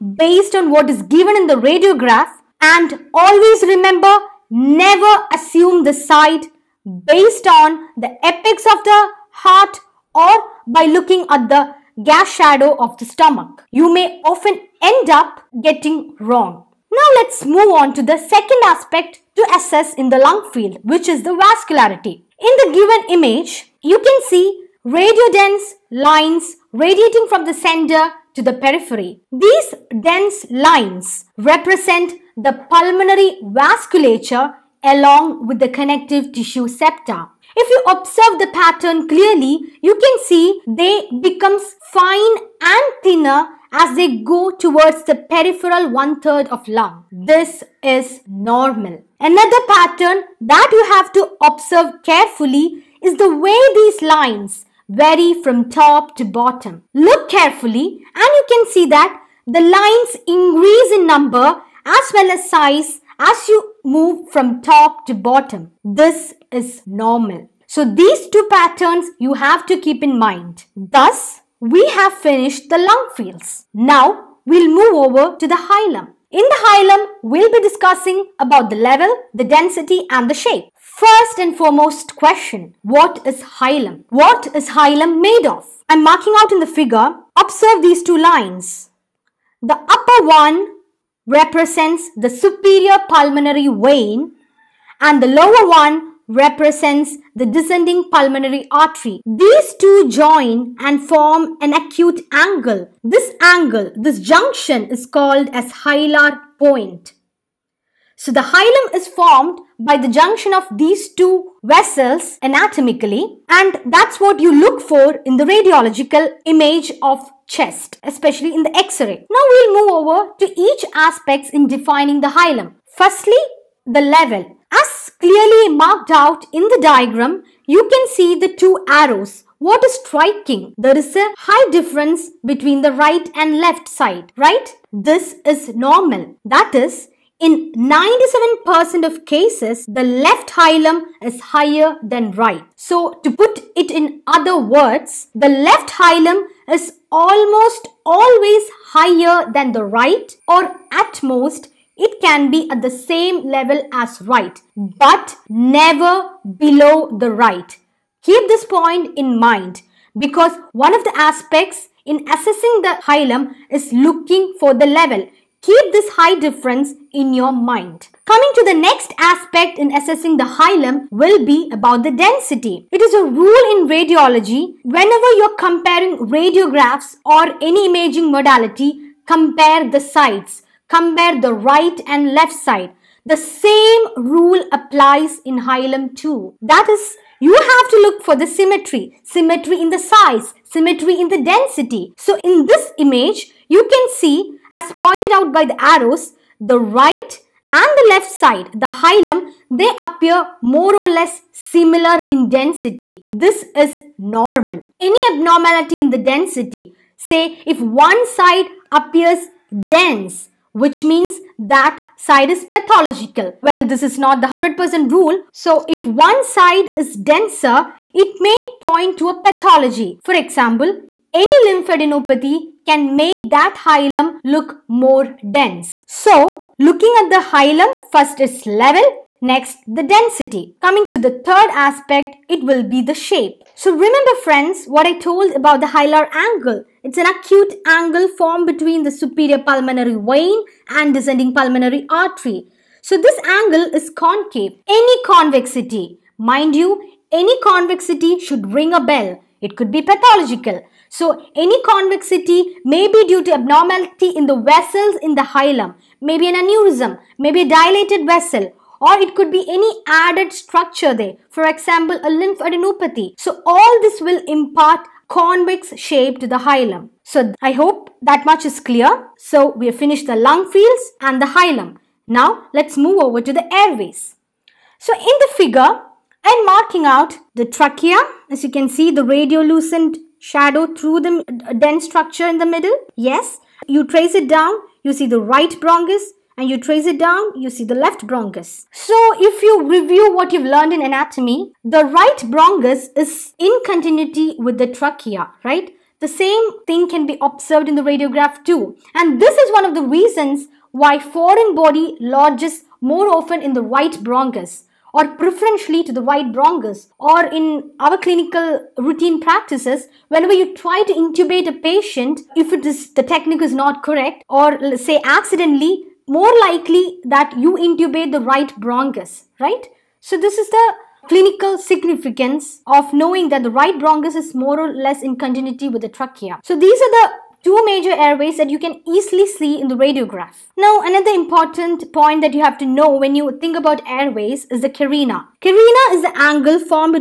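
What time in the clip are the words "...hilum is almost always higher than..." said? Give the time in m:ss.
2:25.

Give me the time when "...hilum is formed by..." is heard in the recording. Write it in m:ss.
1:48.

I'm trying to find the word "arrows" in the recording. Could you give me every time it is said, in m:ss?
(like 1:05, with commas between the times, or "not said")
2:08, 3:15.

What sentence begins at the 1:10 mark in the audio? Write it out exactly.
Thus, we have finished the lung fields.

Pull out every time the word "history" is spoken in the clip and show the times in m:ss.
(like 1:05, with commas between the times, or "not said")
not said.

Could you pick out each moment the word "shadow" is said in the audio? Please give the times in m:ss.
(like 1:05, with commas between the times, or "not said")
0:12, 4:40.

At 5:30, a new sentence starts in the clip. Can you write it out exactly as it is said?
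Now, another important point that you have to know when you think about airways is the carina.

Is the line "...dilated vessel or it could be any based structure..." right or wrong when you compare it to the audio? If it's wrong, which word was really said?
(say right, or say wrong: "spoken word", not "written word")
wrong: "added", not "based".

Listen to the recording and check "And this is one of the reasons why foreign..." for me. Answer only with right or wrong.
right.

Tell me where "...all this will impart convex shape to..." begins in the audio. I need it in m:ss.
4:23.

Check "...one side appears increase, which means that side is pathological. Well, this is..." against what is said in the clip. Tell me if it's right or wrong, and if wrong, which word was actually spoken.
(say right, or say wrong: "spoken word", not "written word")
wrong: "dense", not "increase".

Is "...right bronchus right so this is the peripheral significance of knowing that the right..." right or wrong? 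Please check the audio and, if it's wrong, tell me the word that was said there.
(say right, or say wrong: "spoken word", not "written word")
wrong: "clinical", not "peripheral".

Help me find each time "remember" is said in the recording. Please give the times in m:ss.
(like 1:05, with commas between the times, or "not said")
0:03, 3:53.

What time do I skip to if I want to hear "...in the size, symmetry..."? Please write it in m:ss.
3:09.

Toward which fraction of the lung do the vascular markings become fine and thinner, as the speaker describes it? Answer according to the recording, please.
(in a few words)
Peripheral one-third.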